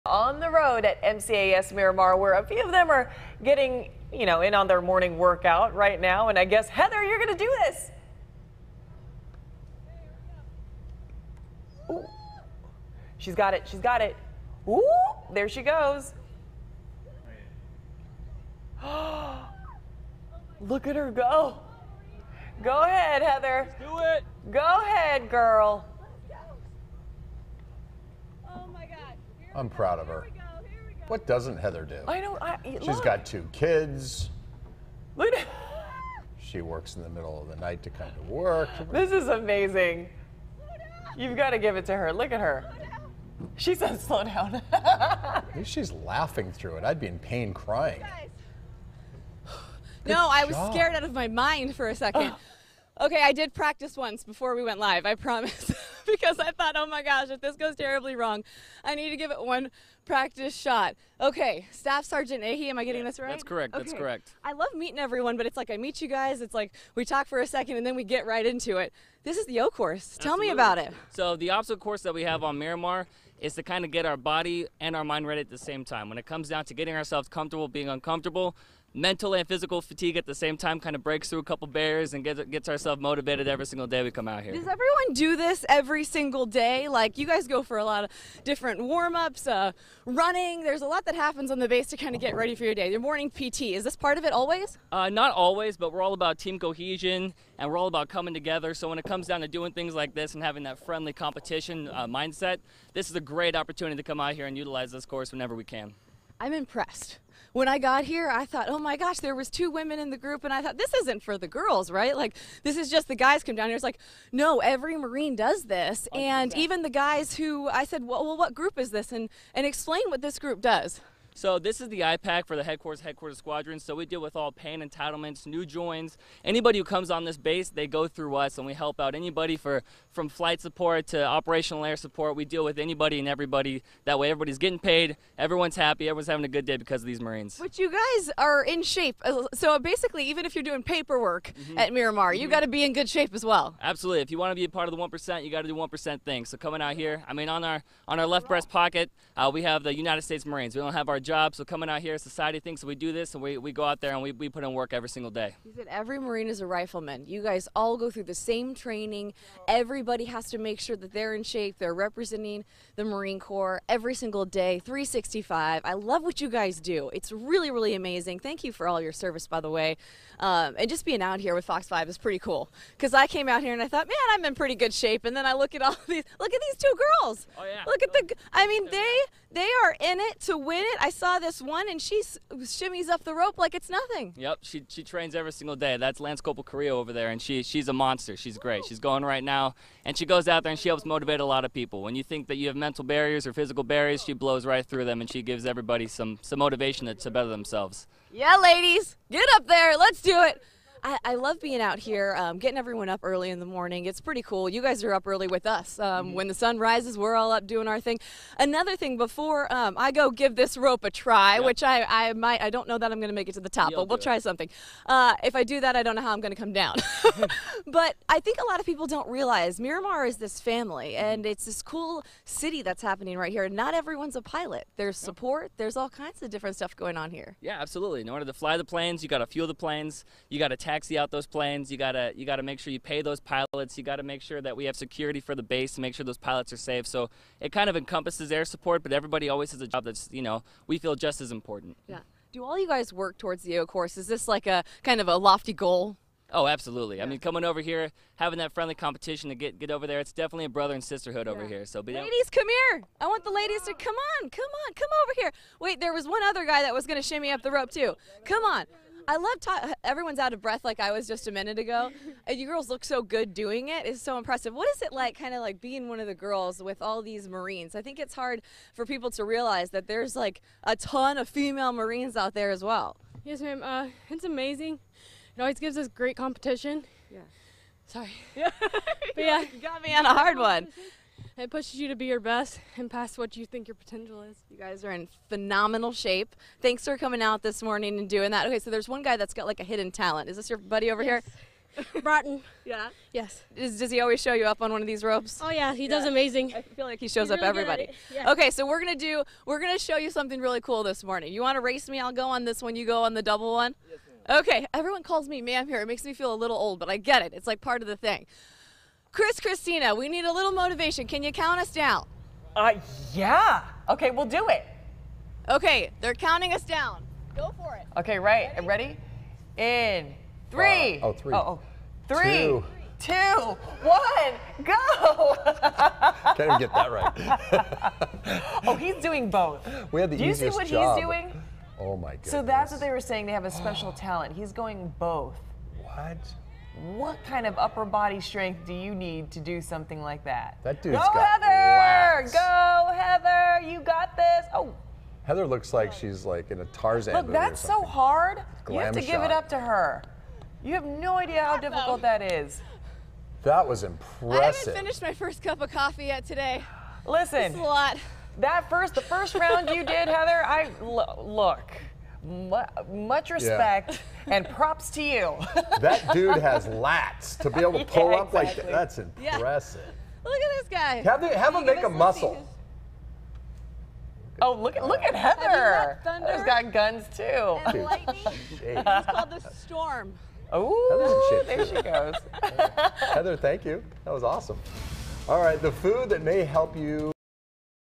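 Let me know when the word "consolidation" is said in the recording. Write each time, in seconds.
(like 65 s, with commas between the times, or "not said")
not said.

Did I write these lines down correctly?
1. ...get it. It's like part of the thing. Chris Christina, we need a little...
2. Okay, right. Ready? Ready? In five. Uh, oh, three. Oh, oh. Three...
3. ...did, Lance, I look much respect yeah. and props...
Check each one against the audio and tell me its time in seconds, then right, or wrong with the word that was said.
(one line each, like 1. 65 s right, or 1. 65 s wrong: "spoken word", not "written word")
1. 307 s right
2. 318 s wrong: "three", not "five"
3. 360 s wrong: "Heather", not "Lance".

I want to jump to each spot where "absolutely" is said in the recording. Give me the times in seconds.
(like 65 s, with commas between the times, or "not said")
70 s, 143 s, 227 s, 246 s.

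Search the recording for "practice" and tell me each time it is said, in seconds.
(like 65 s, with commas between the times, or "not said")
53 s, 60 s.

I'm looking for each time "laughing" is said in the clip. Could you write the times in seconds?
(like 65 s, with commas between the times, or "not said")
45 s.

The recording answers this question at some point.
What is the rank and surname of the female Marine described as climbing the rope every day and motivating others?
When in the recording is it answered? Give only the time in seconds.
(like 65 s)
186 s.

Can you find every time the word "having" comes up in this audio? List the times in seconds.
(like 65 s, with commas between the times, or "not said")
100 s, 136 s, 248 s.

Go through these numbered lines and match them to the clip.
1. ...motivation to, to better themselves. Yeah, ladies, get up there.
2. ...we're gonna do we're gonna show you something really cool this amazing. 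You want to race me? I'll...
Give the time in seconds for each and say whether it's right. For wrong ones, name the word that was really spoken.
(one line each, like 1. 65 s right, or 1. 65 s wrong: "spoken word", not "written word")
1. 196 s right
2. 298 s wrong: "morning", not "amazing".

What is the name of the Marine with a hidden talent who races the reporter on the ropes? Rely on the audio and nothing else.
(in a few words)
Broughton.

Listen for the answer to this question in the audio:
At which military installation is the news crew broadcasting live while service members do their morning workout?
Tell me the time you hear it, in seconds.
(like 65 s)
1 s.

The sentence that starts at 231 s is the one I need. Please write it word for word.
You gotta you gotta make sure you pay those pilots.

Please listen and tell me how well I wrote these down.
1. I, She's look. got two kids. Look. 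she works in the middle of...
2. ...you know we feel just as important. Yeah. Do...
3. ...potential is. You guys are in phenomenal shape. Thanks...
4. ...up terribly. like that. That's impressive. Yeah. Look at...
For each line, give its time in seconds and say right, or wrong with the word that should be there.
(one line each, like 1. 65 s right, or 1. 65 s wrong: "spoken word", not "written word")
1. 32 s right
2. 240 s right
3. 283 s right
4. 368 s wrong: "exactly", not "terribly".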